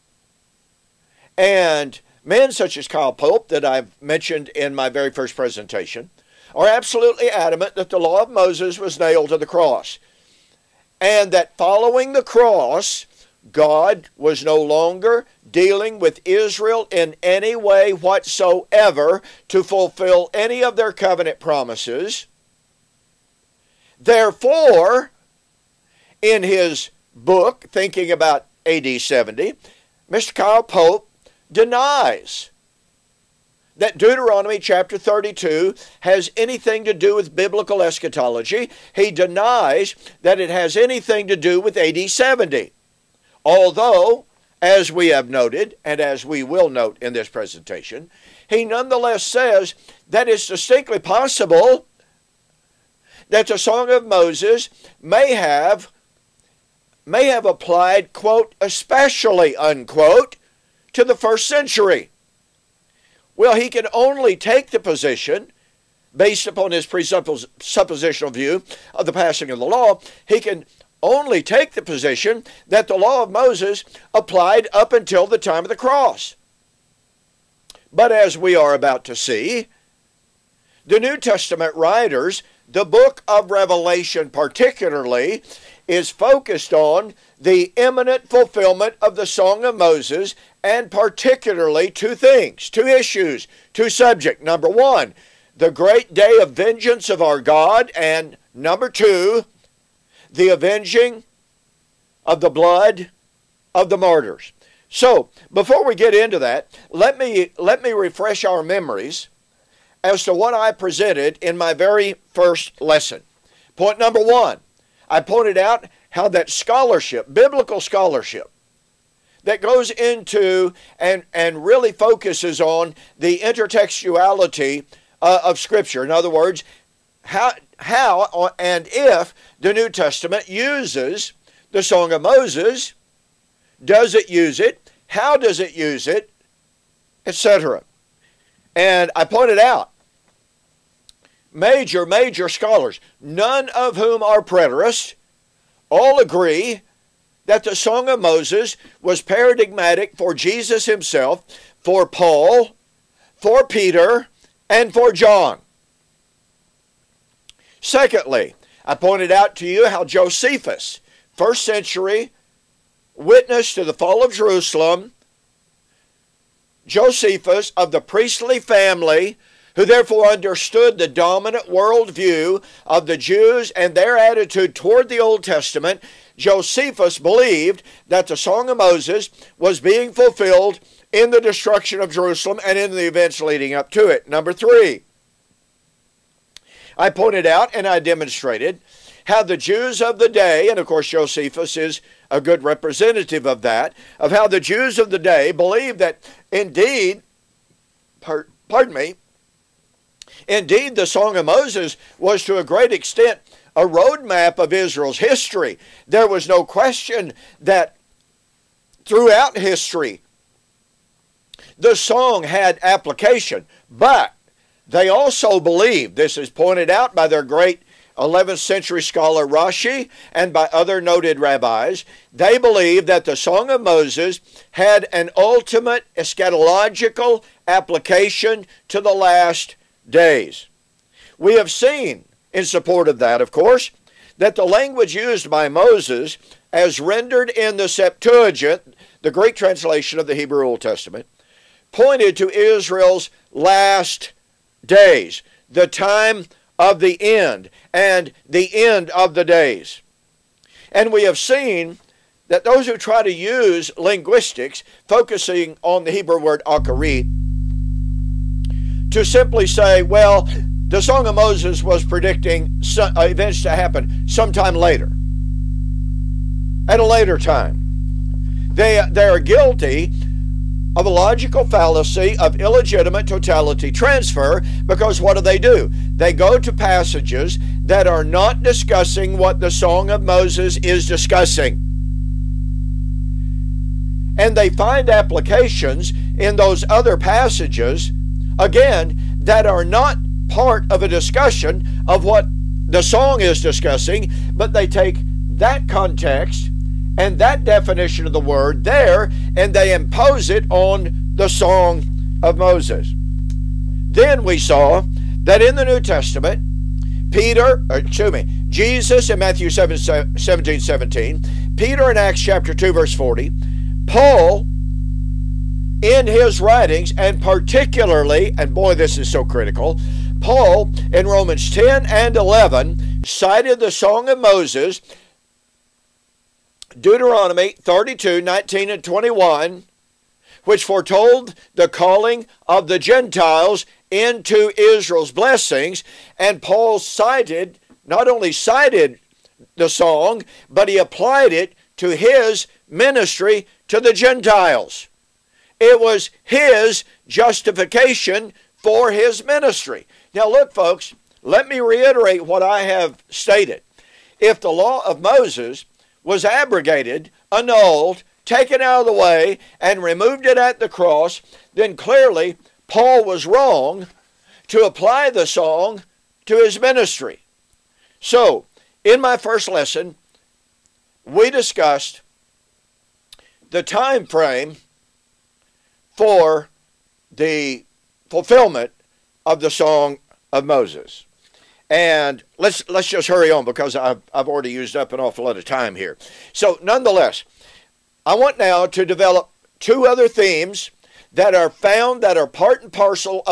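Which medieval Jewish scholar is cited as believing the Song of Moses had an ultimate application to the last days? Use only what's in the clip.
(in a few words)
Rashi.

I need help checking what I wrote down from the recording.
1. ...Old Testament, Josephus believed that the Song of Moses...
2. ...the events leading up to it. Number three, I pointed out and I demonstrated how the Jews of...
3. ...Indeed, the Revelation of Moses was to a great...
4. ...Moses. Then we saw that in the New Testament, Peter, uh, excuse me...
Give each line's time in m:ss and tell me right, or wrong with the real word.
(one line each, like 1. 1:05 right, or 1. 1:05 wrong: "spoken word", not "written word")
1. 2:55 right
2. 3:02 right
3. 3:20 wrong: "Song", not "Revelation"
4. 5:02 right.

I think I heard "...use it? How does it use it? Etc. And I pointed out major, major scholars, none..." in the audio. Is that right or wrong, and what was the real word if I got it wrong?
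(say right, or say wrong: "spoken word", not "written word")
right.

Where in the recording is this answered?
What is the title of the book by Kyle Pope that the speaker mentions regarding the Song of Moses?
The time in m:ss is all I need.
0:27.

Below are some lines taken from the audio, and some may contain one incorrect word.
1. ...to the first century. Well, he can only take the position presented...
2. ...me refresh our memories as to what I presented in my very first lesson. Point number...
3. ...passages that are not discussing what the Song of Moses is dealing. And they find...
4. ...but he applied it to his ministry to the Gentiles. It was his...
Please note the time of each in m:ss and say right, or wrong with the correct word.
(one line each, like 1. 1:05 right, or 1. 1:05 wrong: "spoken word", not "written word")
1. 1:00 wrong: "based", not "presented"
2. 1:47 right
3. 4:36 wrong: "discussing", not "dealing"
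4. 5:40 right.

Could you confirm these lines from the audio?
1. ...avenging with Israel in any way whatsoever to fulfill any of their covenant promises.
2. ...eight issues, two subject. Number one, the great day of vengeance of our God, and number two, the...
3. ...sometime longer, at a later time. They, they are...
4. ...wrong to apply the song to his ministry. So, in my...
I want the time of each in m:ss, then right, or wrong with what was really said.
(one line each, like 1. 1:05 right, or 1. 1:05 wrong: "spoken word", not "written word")
1. 0:15 wrong: "dealing", not "avenging"
2. 1:32 wrong: "two", not "eight"
3. 4:24 wrong: "later", not "longer"
4. 6:03 right.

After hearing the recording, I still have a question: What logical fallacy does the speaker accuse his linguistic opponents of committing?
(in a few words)
Illegitimate totality transfer.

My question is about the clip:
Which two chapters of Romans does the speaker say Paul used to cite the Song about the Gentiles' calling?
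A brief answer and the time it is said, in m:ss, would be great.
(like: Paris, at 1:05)
Romans 10 and 11, at 5:21.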